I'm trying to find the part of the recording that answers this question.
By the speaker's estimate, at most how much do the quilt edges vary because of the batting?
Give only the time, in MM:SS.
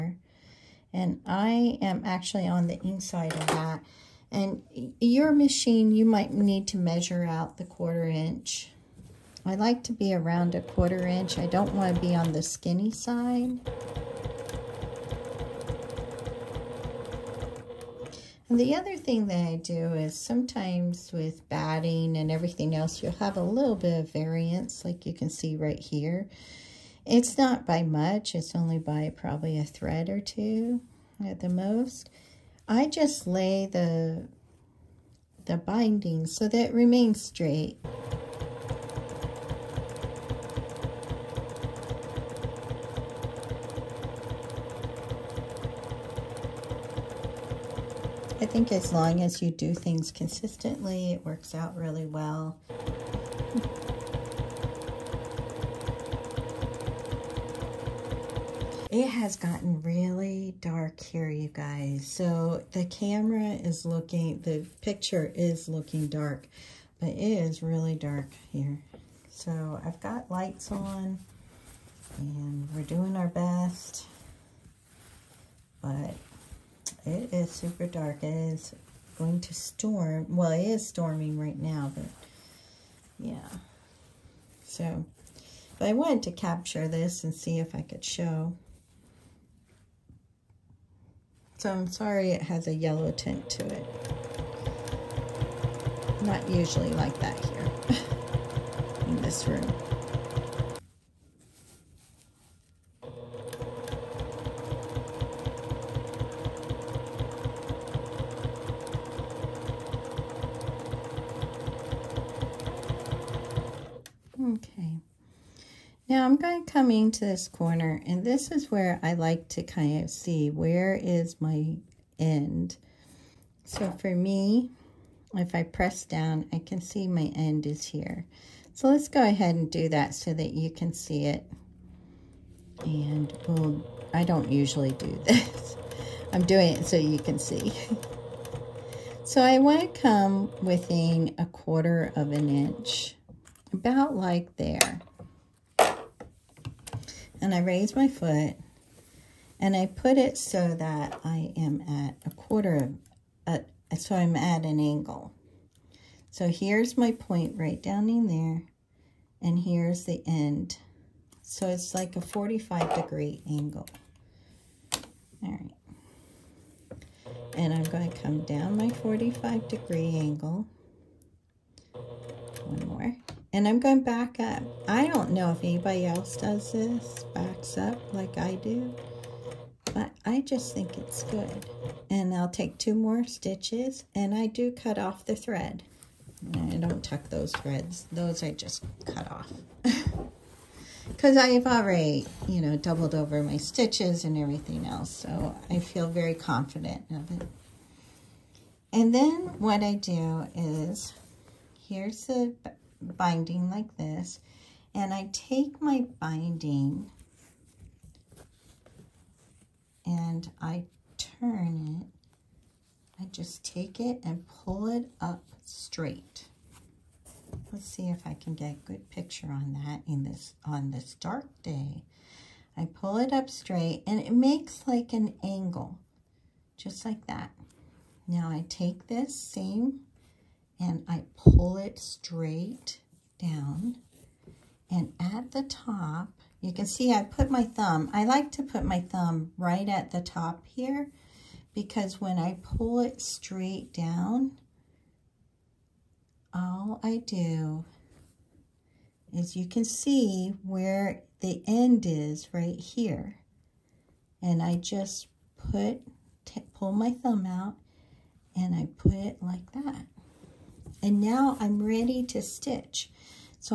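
00:29.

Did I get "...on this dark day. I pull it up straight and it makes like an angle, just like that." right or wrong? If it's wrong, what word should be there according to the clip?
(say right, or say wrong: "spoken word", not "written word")
right.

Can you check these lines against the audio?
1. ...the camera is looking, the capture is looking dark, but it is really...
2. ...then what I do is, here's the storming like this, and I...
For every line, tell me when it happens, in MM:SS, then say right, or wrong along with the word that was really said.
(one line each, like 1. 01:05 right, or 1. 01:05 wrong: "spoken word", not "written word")
1. 01:02 wrong: "picture", not "capture"
2. 03:19 wrong: "binding", not "storming".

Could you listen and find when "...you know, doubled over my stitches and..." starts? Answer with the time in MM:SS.
03:12.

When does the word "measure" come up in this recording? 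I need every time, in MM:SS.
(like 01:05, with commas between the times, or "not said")
00:06.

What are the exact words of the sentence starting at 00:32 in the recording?
I just lay the, the binding so that it remains straight.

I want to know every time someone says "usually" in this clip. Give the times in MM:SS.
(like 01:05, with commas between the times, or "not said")
01:36, 02:14.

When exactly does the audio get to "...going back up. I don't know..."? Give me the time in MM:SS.
02:53.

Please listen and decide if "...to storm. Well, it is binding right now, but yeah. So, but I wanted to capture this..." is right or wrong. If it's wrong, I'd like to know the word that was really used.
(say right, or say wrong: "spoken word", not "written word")
wrong: "storming", not "binding".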